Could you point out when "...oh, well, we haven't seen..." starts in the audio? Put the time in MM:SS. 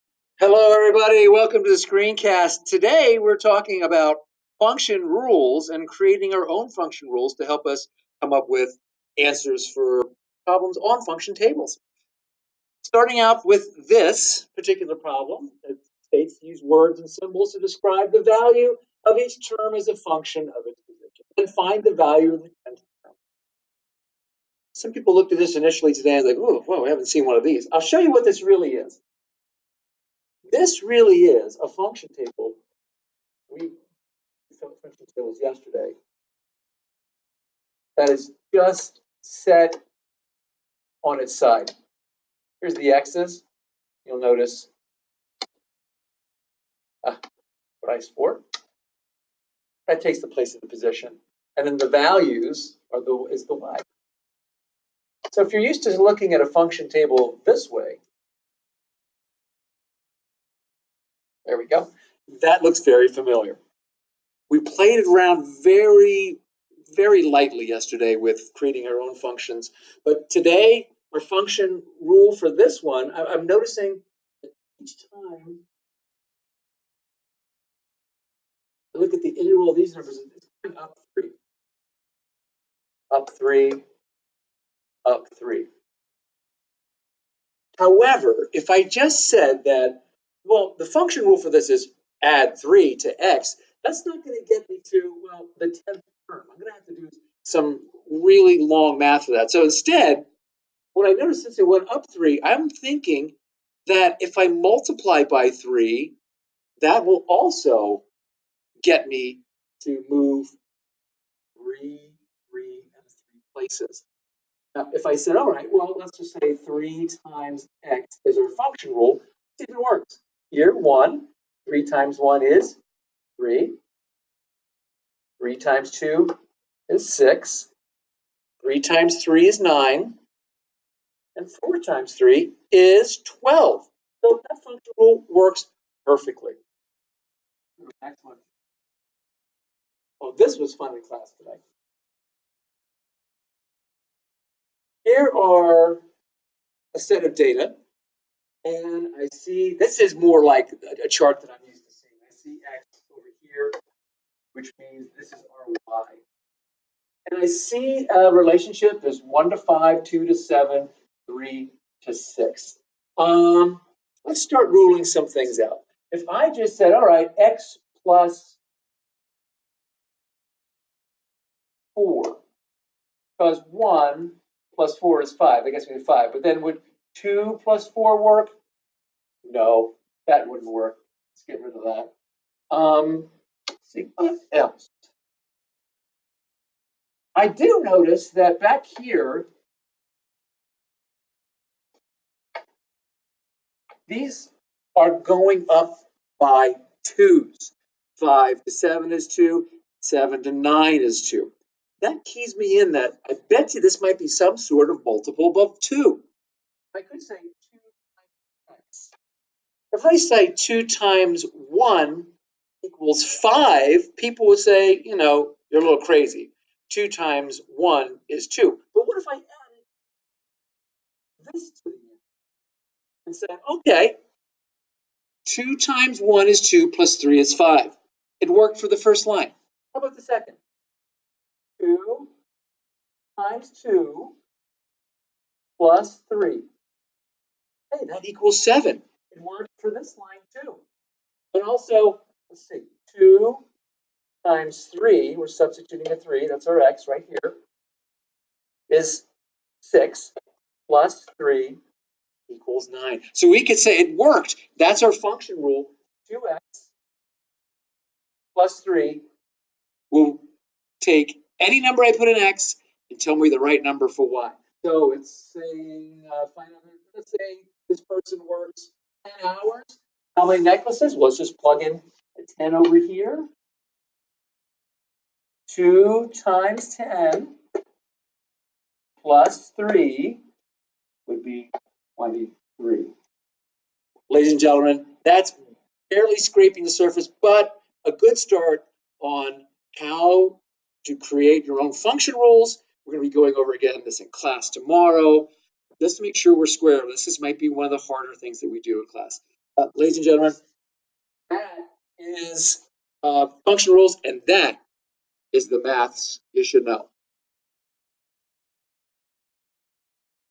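00:26.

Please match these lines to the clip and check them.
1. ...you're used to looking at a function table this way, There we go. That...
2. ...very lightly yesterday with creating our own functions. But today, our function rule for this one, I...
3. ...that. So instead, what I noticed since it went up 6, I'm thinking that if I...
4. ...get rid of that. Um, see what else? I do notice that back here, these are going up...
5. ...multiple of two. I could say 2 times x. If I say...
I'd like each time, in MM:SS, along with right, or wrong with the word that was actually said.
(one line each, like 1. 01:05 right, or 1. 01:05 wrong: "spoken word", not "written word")
1. 00:55 right
2. 01:06 right
3. 01:39 wrong: "3", not "6"
4. 03:01 right
5. 03:25 right.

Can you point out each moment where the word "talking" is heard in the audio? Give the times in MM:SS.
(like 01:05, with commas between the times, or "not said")
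00:03.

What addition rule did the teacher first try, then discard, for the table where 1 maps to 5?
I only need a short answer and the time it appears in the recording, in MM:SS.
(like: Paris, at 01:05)
X plus 4, at 02:47.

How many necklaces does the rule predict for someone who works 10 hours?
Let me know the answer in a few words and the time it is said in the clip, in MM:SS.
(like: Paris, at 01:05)
23, at 04:42.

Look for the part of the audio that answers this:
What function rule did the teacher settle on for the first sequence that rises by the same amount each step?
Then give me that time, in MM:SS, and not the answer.
01:56.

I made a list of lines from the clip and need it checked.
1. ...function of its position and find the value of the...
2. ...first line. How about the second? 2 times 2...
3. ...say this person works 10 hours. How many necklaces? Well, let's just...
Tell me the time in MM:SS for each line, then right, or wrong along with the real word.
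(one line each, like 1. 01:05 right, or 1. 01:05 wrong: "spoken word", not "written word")
1. 00:19 right
2. 03:48 right
3. 04:27 right.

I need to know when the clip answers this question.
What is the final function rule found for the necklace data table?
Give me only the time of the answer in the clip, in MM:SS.
04:16.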